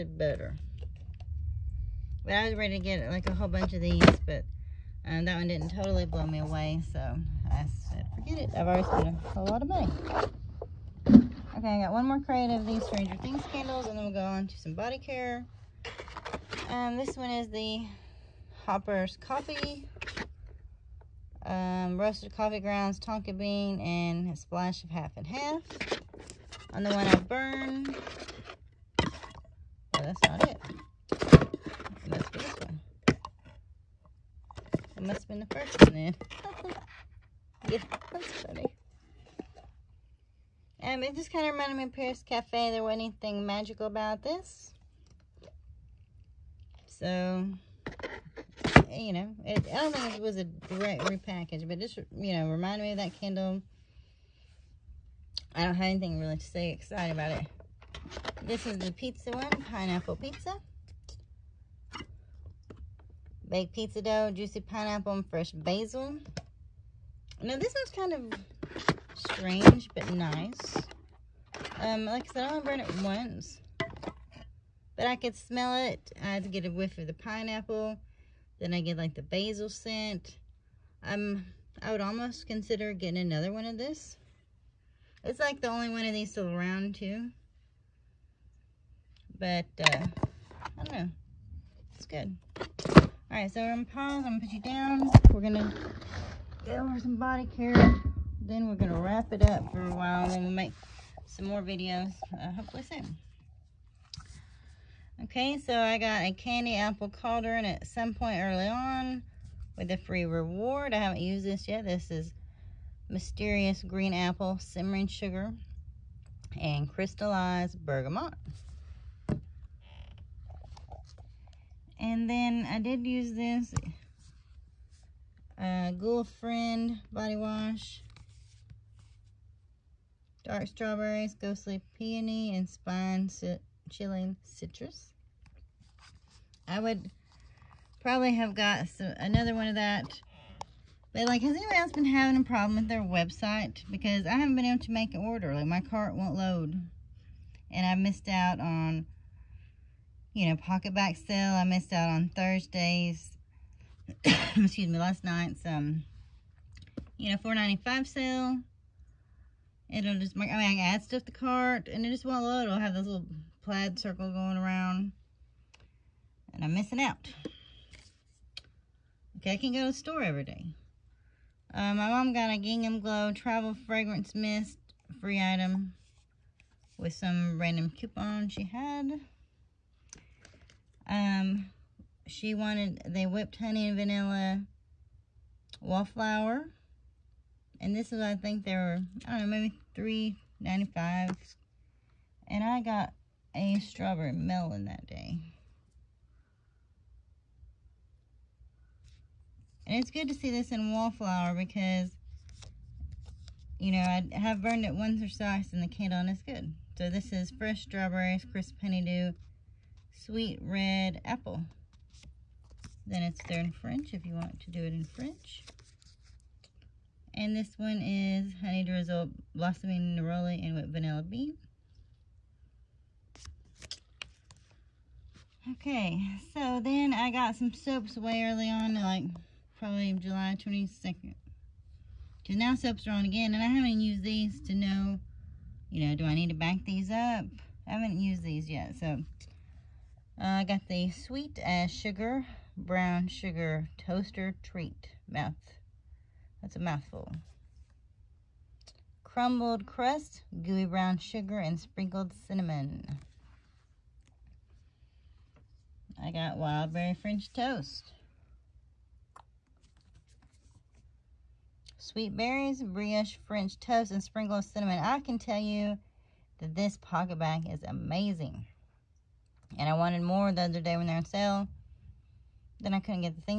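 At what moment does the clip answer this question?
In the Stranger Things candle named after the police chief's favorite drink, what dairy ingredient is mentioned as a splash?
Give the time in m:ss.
0:24.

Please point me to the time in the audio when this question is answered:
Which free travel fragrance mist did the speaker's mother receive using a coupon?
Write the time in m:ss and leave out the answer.
2:52.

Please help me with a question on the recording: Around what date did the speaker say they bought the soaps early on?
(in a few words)
July 22nd.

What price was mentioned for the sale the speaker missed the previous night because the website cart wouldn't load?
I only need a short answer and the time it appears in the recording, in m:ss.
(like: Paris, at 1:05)
$4.95, at 2:37.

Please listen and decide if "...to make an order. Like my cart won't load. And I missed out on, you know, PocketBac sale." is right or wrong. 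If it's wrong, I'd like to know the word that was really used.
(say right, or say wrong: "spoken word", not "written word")
right.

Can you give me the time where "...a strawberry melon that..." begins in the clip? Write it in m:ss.
3:13.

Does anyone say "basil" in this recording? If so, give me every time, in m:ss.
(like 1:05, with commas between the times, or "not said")
1:05, 1:19.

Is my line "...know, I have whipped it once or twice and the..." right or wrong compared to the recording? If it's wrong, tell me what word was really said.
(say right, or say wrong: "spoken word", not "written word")
wrong: "burned", not "whipped".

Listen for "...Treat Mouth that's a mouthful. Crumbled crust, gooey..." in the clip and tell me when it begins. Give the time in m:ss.
4:04.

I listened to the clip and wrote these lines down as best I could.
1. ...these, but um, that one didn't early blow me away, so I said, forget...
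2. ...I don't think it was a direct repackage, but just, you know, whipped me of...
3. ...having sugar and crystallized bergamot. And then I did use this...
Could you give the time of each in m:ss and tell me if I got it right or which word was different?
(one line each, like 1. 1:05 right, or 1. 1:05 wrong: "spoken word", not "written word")
1. 0:03 wrong: "totally", not "early"
2. 0:49 wrong: "reminded", not "whipped"
3. 1:54 wrong: "simmering", not "having".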